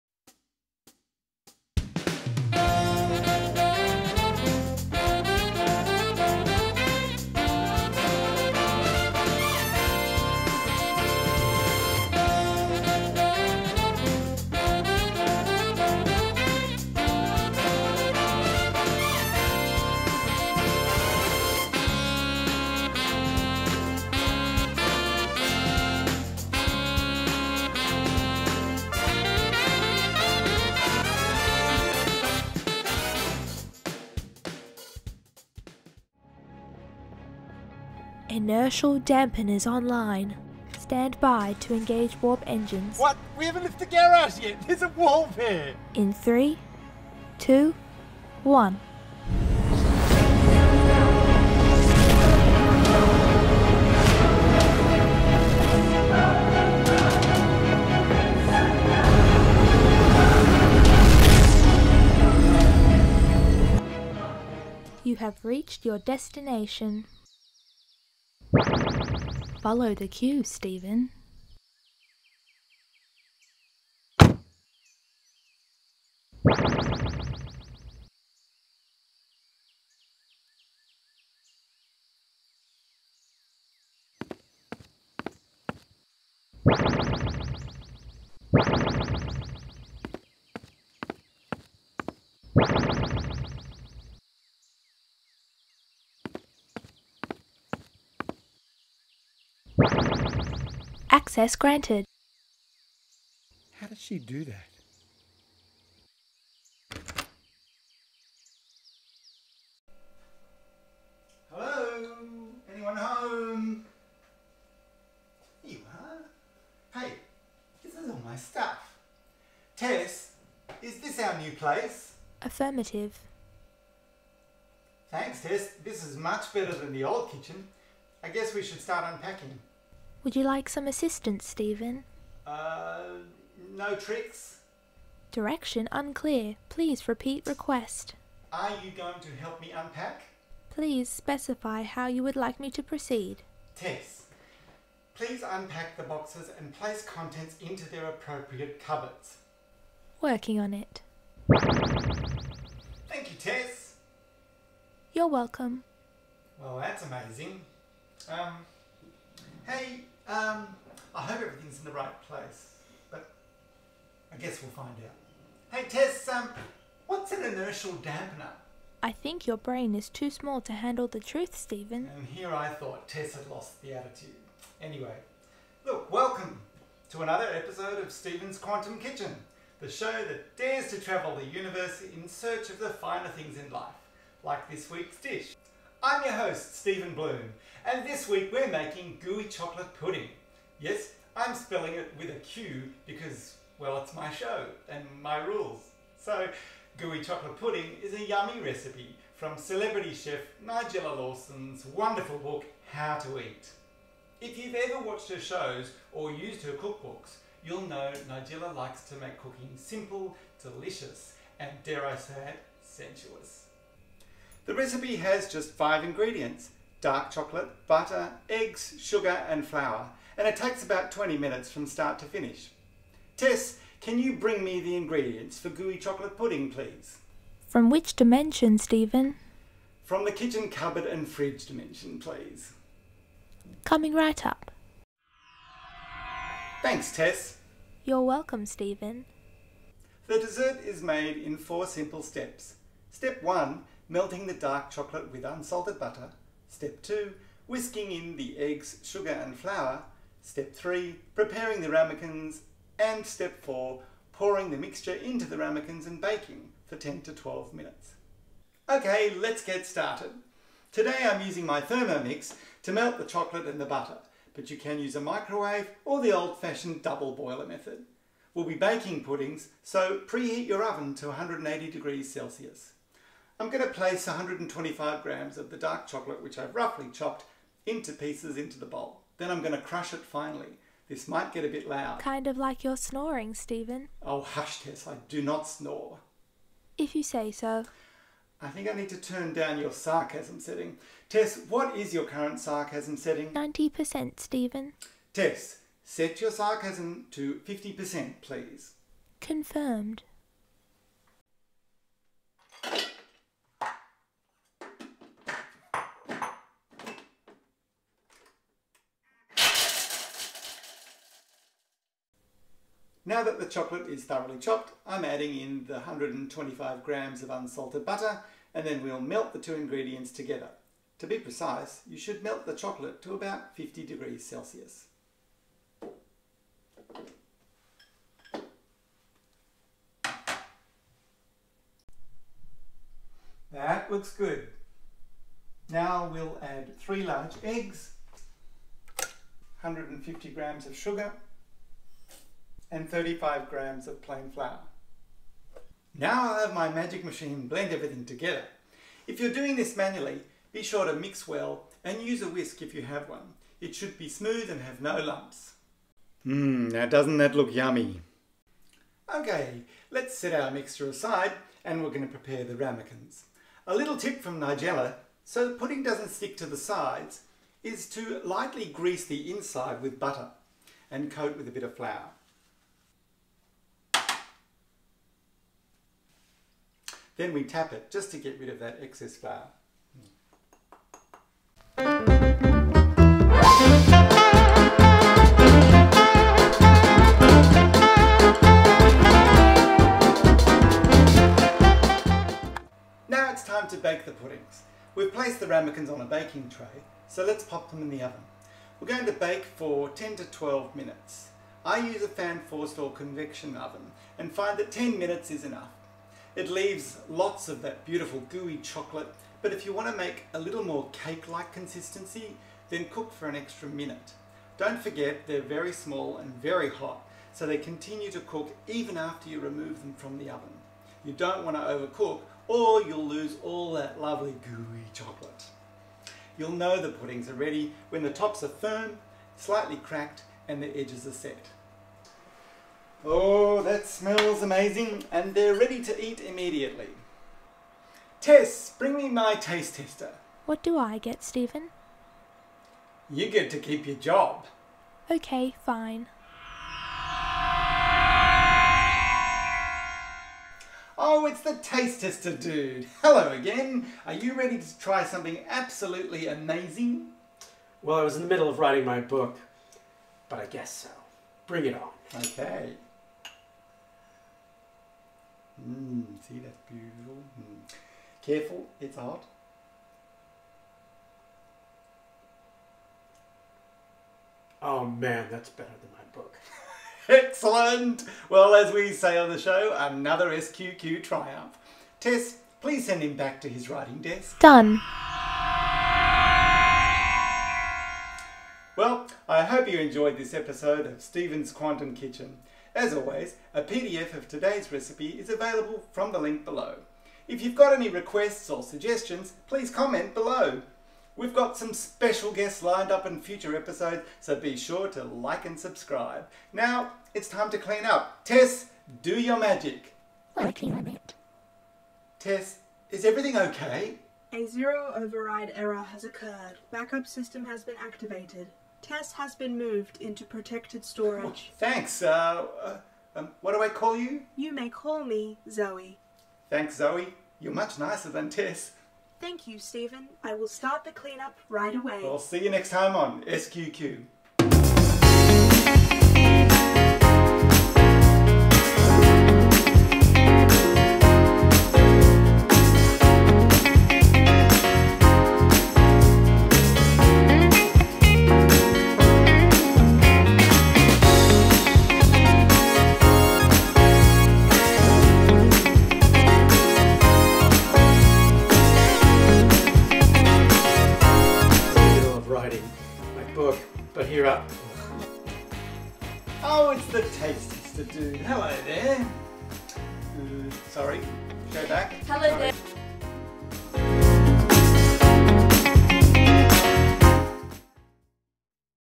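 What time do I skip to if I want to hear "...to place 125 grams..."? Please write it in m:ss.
4:33.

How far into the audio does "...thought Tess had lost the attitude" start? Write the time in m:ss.
2:52.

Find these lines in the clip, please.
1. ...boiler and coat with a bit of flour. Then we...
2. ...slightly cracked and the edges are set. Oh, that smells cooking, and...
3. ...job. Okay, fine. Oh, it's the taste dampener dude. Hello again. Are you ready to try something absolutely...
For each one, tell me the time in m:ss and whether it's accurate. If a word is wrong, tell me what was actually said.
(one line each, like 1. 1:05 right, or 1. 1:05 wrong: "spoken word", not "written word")
1. 6:10 wrong: "butter", not "boiler"
2. 7:09 wrong: "amazing", not "cooking"
3. 7:24 wrong: "tester", not "dampener".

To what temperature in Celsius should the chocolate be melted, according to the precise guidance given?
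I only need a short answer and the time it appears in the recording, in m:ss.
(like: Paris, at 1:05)
50 degrees Celsius, at 5:23.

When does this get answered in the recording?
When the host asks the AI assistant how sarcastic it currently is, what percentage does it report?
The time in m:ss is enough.
4:53.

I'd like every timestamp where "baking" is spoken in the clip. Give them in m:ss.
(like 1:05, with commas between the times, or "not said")
4:16, 4:28, 6:36.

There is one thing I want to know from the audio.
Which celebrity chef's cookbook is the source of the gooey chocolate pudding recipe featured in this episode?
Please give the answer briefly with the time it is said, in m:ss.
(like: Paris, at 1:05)
Nigella Lawson, at 3:20.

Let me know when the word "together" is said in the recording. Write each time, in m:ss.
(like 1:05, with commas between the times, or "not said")
5:20, 5:48.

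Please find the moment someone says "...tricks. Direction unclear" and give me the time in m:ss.
2:13.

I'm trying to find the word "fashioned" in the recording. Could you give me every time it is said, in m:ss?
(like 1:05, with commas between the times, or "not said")
4:26.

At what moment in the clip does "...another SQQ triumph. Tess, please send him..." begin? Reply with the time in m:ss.
7:59.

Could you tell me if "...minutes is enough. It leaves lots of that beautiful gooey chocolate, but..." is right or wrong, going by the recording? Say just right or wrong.
right.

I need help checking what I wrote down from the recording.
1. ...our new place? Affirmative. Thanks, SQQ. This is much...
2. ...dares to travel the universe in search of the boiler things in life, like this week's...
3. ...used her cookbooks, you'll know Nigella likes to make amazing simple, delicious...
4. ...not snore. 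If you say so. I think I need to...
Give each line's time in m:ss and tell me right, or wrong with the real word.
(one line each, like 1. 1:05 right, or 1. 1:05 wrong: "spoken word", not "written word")
1. 2:01 wrong: "Tess", not "SQQ"
2. 3:00 wrong: "finer", not "boiler"
3. 3:26 wrong: "cooking", not "amazing"
4. 4:45 right.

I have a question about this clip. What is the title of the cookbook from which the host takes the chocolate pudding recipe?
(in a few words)
How to Eat.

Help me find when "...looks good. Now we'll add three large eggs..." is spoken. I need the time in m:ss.
5:34.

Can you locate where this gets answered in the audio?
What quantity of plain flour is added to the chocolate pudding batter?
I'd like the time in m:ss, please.
5:43.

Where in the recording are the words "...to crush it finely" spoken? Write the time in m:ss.
4:39.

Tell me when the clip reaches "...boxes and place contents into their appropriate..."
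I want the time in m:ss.
2:26.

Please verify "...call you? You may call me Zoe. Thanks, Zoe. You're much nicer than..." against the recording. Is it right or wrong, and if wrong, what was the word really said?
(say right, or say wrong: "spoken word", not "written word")
right.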